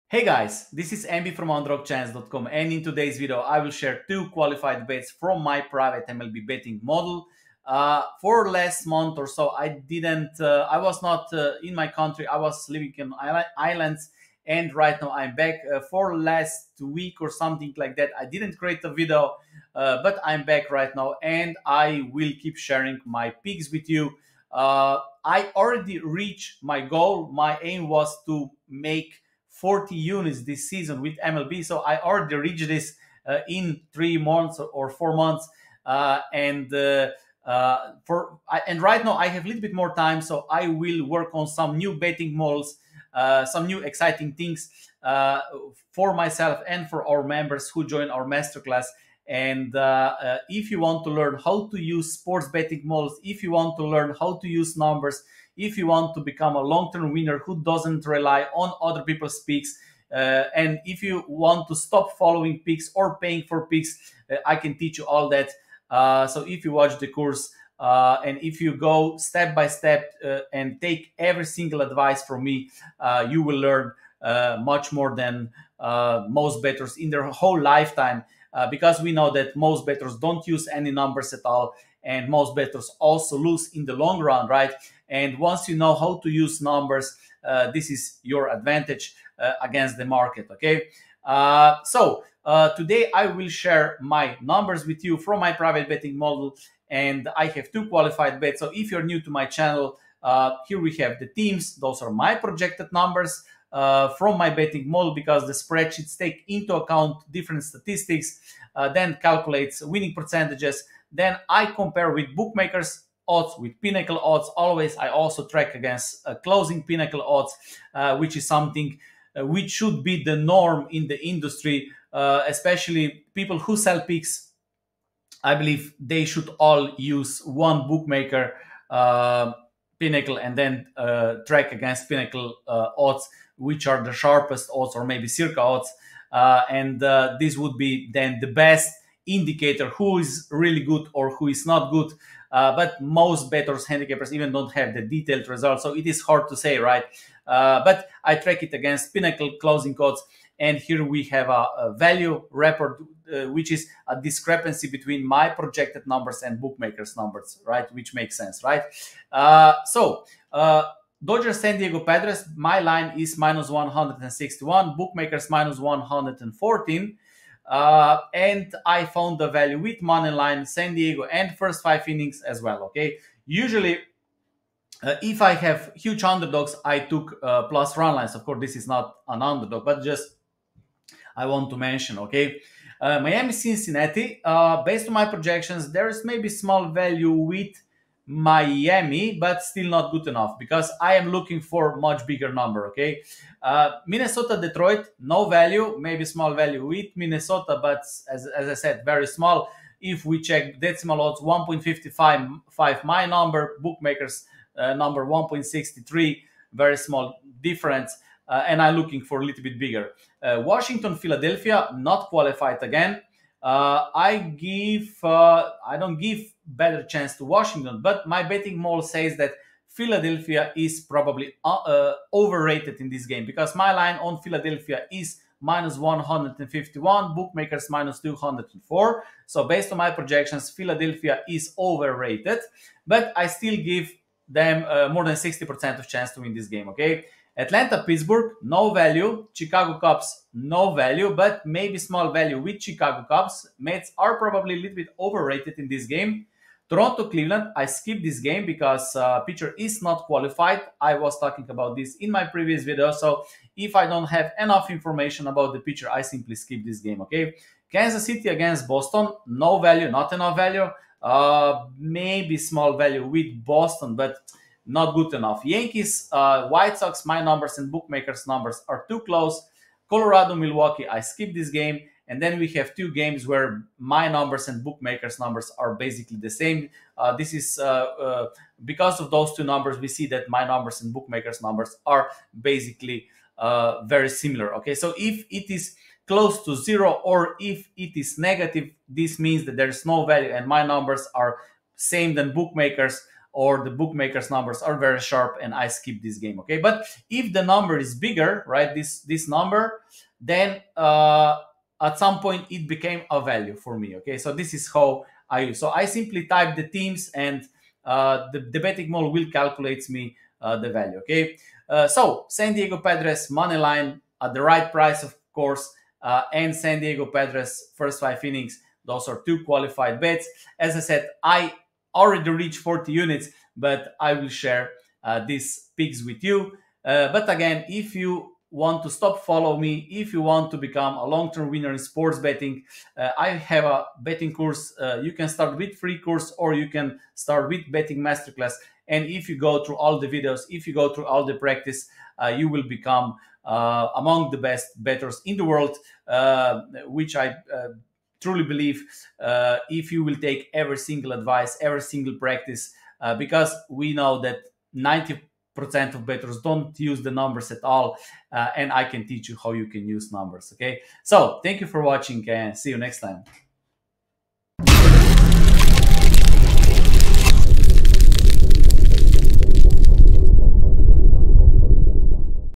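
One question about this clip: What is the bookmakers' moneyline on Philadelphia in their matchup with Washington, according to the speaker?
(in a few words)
-204.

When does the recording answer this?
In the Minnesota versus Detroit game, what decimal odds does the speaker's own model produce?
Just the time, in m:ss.
3:21.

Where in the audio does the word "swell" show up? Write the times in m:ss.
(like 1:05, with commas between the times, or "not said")
not said.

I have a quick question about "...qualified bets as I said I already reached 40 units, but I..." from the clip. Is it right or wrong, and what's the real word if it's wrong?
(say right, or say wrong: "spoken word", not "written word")
right.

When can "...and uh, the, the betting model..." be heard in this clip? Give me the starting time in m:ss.
5:07.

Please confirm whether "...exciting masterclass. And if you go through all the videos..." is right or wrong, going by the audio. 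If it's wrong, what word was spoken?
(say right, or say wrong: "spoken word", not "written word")
wrong: "betting", not "exciting".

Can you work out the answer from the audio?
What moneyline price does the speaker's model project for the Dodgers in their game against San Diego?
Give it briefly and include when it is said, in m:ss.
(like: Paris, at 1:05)
-161, at 2:43.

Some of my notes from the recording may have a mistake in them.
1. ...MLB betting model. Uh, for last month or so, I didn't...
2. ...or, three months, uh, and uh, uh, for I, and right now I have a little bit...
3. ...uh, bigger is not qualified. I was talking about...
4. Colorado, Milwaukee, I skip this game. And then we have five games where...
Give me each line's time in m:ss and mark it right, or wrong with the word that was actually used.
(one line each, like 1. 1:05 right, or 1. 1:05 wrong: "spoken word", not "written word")
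1. 0:06 right
2. 0:34 wrong: "four", not "three"
3. 4:09 wrong: "pitcher", not "bigger"
4. 4:30 wrong: "two", not "five".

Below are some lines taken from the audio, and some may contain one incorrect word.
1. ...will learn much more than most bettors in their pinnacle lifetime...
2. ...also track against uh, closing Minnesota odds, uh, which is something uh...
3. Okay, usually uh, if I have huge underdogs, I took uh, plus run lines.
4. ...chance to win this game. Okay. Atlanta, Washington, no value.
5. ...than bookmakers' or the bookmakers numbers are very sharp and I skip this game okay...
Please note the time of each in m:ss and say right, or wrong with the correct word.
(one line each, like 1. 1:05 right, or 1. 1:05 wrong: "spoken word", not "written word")
1. 1:13 wrong: "whole", not "pinnacle"
2. 1:55 wrong: "Pinnacle", not "Minnesota"
3. 2:52 right
4. 3:56 wrong: "Pittsburgh", not "Washington"
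5. 4:52 right.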